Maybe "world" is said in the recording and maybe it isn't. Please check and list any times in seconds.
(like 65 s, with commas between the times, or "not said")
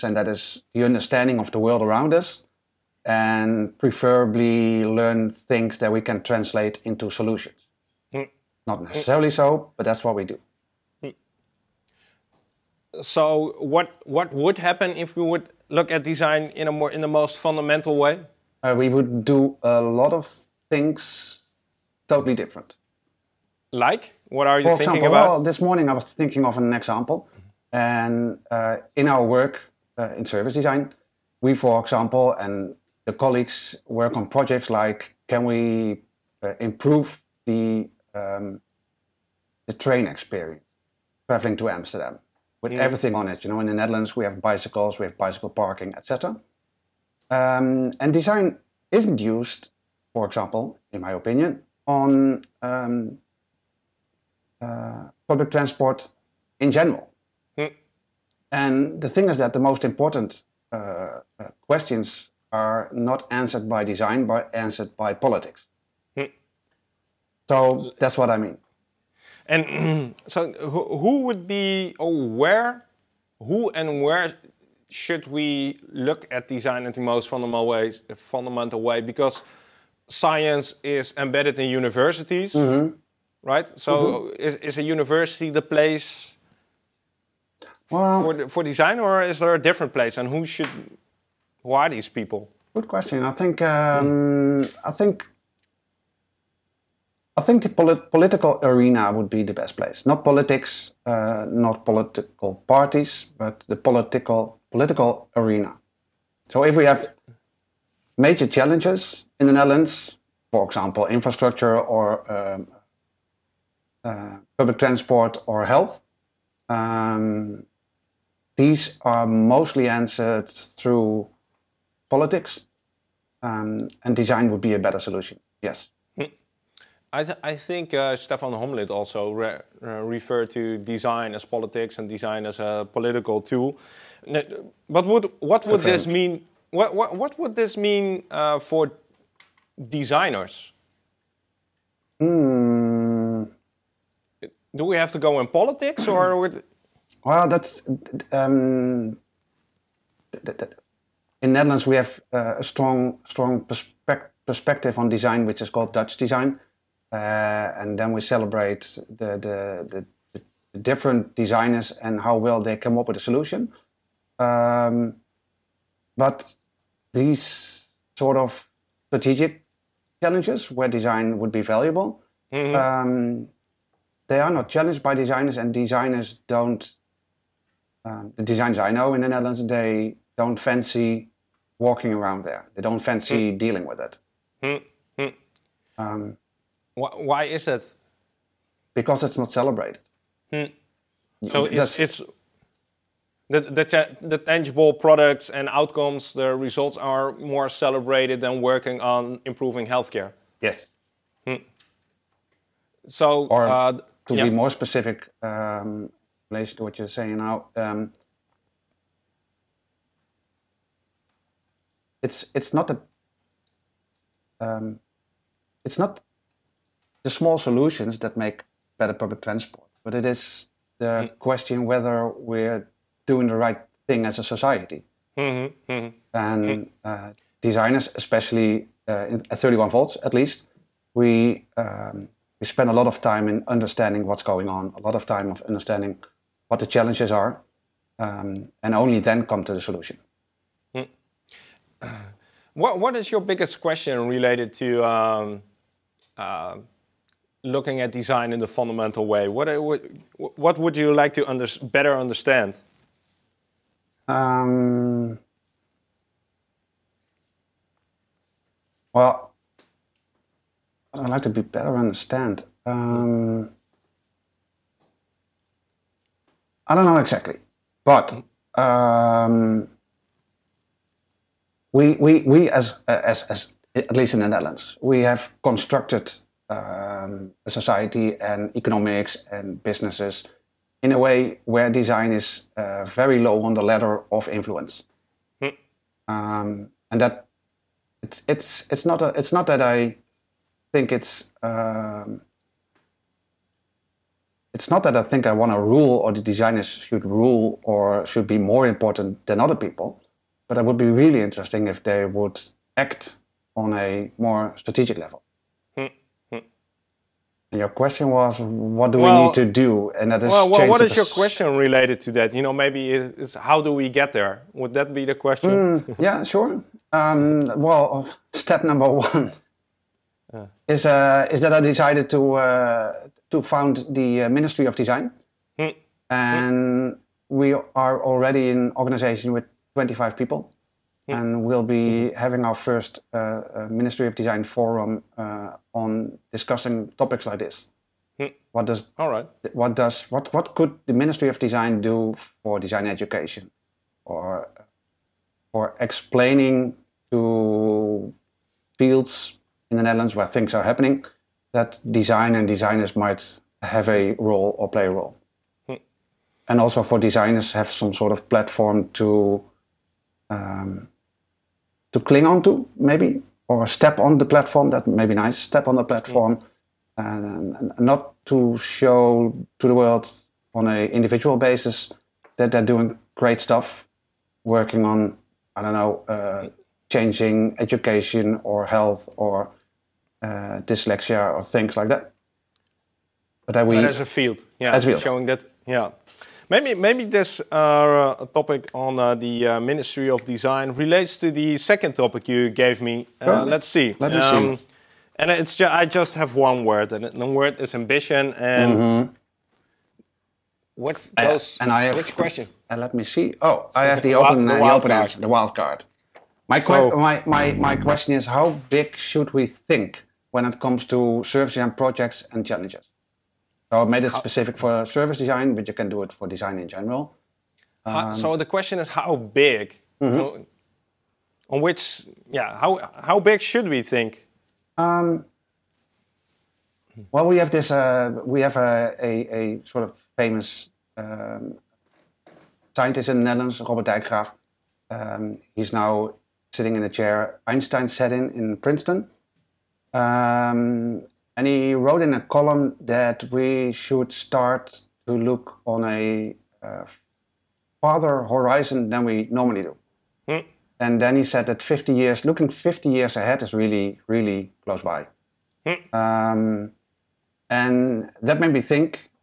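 1 s, 369 s.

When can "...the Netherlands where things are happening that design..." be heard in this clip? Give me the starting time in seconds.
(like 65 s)
349 s.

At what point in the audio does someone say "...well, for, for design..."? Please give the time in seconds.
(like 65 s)
87 s.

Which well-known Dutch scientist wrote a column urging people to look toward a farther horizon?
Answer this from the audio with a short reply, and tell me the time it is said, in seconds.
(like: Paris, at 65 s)
Robert Dijkgraaf, at 433 s.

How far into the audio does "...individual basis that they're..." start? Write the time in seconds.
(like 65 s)
371 s.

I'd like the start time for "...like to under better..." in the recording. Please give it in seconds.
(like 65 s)
251 s.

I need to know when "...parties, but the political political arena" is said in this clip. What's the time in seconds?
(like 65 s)
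102 s.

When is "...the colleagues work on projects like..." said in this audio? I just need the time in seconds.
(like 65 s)
33 s.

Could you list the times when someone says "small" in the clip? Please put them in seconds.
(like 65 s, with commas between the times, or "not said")
217 s.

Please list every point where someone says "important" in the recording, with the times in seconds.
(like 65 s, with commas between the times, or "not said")
59 s, 298 s.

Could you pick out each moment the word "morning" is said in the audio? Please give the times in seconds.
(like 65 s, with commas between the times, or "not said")
25 s.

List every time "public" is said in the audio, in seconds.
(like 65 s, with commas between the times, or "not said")
55 s, 114 s, 219 s.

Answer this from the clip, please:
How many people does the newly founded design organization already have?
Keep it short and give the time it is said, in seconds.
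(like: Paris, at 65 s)
25, at 329 s.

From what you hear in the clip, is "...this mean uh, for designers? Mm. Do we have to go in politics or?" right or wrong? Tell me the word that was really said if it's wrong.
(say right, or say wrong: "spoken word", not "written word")
right.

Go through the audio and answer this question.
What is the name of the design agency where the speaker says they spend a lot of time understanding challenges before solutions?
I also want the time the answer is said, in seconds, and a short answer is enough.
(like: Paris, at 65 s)
31 volts, at 229 s.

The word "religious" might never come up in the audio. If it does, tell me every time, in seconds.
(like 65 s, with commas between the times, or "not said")
not said.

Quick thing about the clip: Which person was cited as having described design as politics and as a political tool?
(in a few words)
Stefan Homlid.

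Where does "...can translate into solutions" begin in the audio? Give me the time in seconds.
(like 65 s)
6 s.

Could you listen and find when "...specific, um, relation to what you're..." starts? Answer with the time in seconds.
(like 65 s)
204 s.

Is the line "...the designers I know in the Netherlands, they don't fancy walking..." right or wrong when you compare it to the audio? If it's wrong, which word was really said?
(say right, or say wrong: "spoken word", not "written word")
right.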